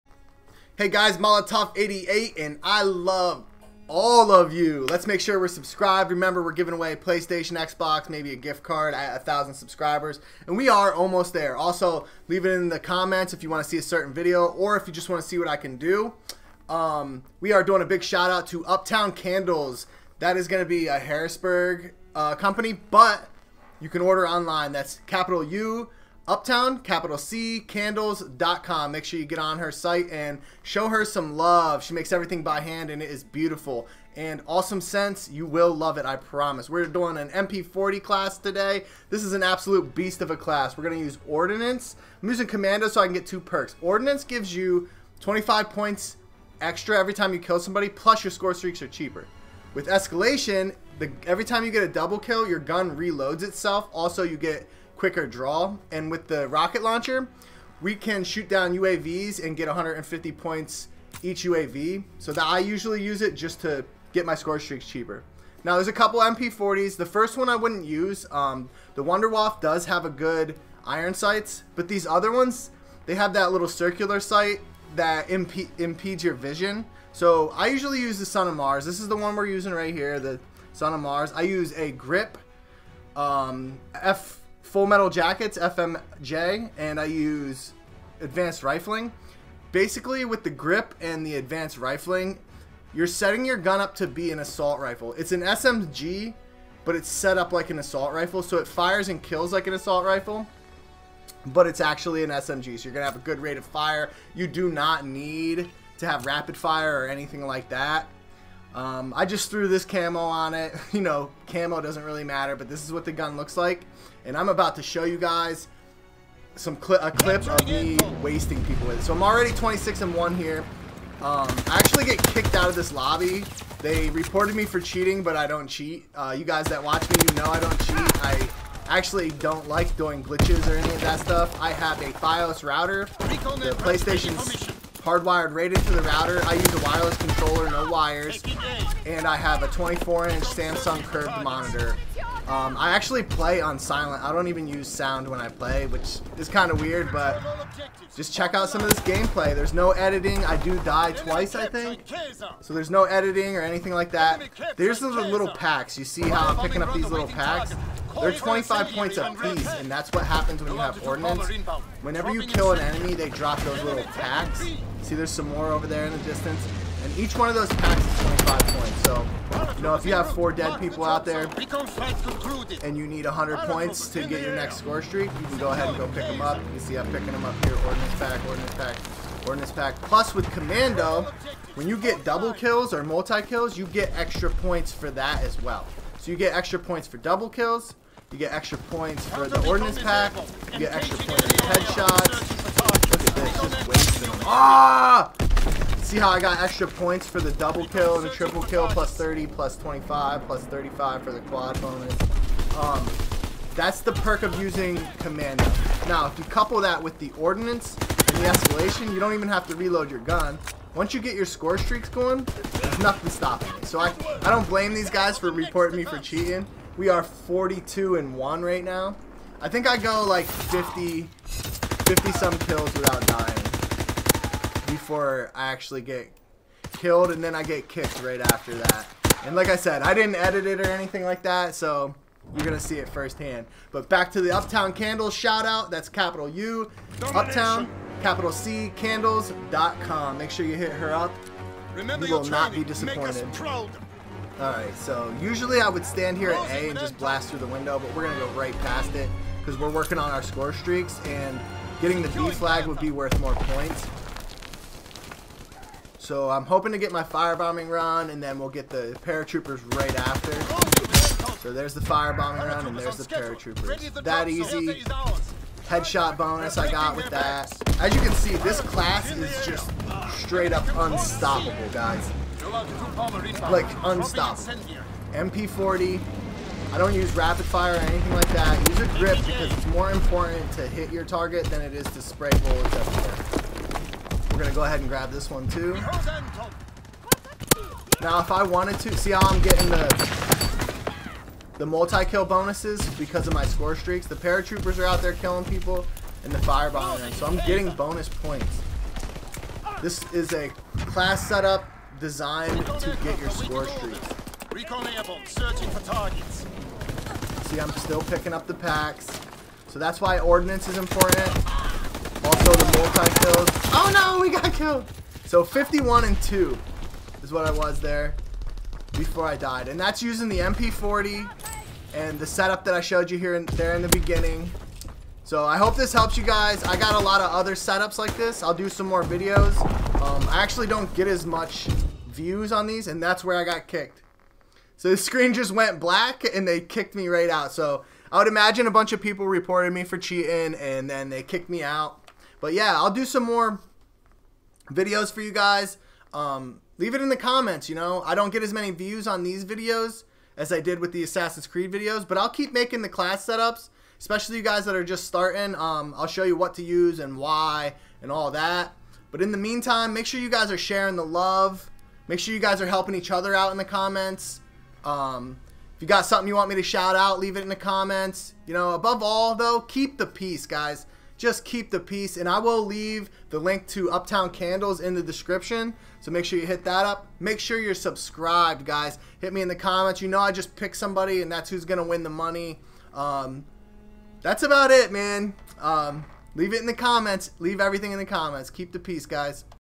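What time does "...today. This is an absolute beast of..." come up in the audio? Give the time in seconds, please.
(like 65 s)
38 s.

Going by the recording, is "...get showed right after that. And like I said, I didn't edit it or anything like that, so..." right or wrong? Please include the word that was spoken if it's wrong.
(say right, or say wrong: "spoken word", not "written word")
wrong: "kicked", not "showed".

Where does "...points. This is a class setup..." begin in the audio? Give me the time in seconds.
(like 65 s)
298 s.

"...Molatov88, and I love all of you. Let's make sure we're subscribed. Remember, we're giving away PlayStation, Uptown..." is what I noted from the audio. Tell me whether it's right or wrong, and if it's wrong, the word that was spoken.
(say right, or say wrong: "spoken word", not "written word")
wrong: "Xbox", not "Uptown".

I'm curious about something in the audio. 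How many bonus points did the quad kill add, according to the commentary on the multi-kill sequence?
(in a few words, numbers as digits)
35.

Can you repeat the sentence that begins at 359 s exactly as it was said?
But in the meantime, make sure you guys are sharing the love.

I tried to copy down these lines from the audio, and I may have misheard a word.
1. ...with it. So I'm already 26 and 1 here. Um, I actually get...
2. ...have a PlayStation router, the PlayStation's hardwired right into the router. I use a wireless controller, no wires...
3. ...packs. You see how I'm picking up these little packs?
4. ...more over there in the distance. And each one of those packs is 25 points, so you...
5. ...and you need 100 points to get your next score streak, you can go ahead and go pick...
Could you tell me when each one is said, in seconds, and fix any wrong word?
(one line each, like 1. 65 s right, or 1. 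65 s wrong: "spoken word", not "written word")
1. 118 s right
2. 131 s wrong: "Fios", not "PlayStation"
3. 155 s right
4. 165 s right
5. 172 s right.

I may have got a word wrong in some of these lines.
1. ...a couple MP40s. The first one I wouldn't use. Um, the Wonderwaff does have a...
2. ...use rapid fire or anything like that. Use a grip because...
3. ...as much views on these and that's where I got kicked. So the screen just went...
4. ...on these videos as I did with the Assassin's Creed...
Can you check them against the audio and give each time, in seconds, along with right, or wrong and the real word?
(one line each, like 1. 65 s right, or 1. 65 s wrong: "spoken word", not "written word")
1. 65 s right
2. 277 s right
3. 331 s right
4. 349 s right.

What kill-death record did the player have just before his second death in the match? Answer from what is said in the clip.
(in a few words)
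51 and 2.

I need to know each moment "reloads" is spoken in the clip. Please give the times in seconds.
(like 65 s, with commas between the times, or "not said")
52 s, 209 s.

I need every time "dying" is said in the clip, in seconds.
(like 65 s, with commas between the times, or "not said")
223 s.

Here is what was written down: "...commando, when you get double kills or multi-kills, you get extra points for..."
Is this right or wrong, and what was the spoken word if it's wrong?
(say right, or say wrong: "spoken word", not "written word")
right.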